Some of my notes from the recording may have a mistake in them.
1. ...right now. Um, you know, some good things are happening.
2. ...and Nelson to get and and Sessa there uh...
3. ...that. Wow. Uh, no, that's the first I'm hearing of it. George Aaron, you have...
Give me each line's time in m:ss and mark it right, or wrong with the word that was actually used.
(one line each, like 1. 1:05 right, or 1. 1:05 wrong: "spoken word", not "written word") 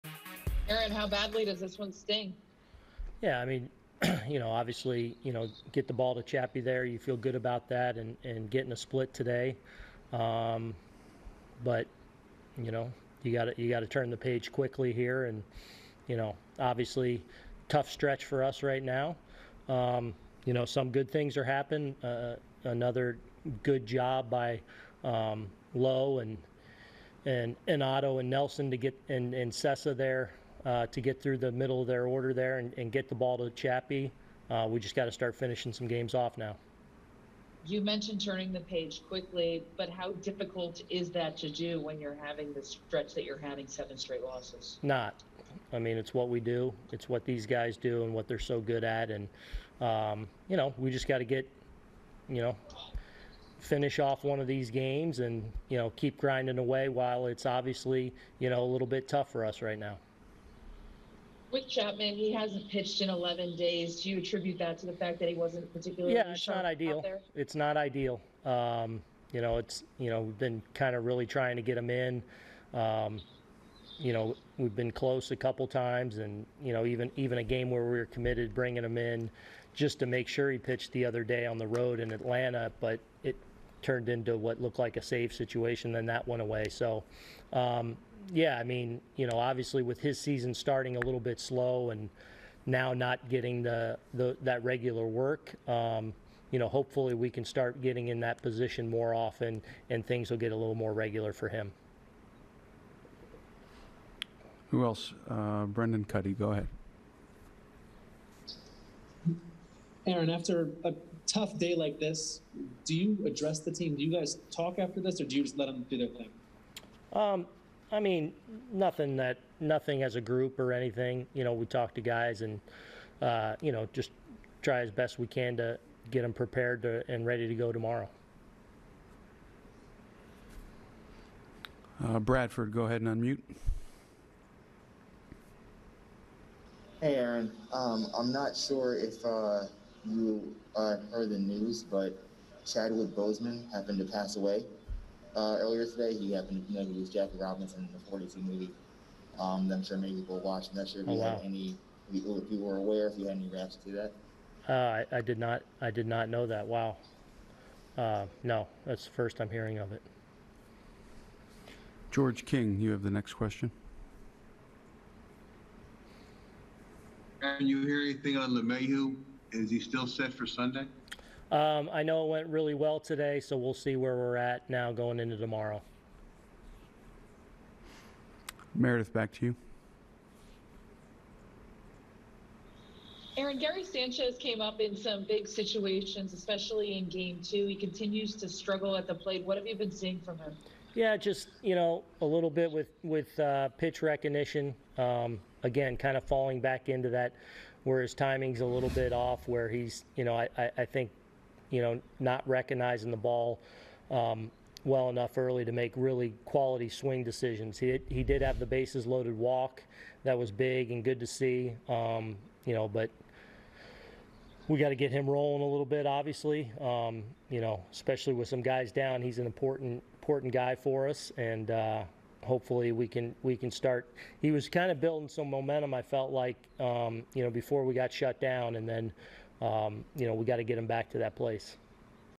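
1. 0:18 right
2. 0:28 right
3. 2:36 wrong: "King", not "Aaron".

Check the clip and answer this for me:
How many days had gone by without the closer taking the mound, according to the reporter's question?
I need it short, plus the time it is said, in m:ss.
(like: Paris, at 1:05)
11, at 1:03.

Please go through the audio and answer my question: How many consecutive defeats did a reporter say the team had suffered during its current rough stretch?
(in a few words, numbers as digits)
7.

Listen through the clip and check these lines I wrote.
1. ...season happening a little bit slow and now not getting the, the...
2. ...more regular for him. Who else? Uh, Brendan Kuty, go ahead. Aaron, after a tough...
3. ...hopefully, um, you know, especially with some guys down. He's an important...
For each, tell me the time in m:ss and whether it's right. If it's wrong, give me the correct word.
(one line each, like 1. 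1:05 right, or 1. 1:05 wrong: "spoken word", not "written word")
1. 1:30 wrong: "starting", not "happening"
2. 1:40 right
3. 3:36 wrong: "obviously", not "hopefully".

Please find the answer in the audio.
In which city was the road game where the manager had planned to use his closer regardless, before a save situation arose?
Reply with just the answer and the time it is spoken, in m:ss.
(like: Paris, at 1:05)
Atlanta, at 1:22.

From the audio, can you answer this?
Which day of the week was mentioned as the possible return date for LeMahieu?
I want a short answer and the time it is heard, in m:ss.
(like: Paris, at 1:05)
Sunday, at 2:50.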